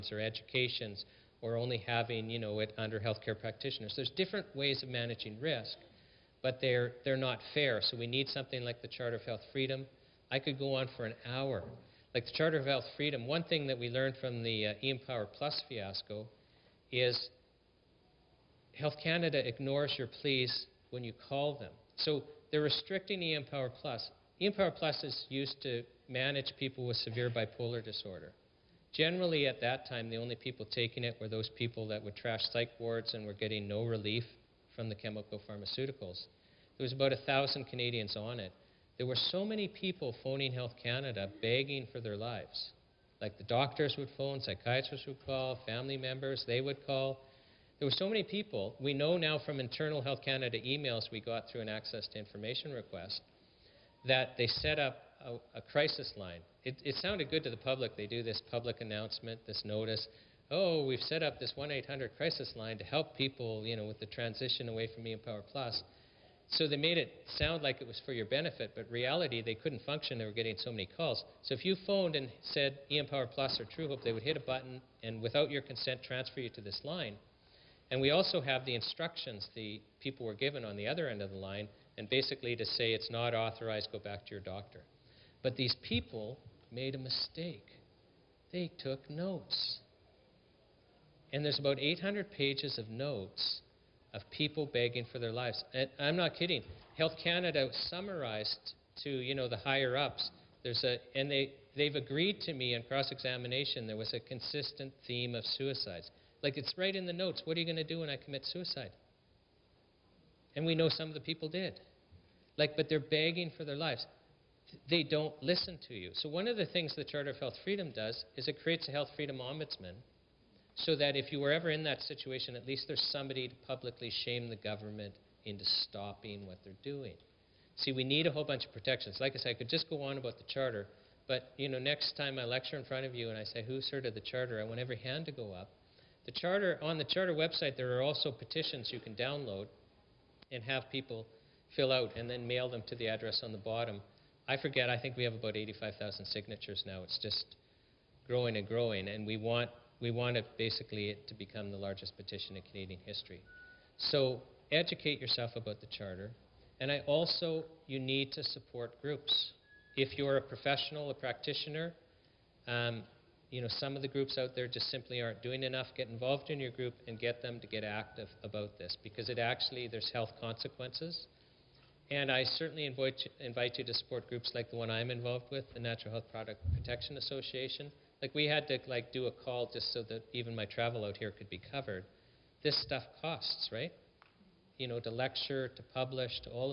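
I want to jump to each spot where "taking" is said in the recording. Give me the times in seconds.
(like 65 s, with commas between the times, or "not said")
30 s.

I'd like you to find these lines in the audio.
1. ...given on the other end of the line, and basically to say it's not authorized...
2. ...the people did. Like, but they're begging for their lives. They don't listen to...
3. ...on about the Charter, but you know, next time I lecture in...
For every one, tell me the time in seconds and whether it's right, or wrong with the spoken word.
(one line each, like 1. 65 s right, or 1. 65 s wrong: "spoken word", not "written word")
1. 80 s right
2. 111 s right
3. 130 s right.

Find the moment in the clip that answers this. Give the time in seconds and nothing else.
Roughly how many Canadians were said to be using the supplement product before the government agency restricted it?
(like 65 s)
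36 s.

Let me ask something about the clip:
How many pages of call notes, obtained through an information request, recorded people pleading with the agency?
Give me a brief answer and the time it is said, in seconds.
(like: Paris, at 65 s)
800, at 91 s.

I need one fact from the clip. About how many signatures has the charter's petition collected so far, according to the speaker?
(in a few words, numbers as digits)
85,000.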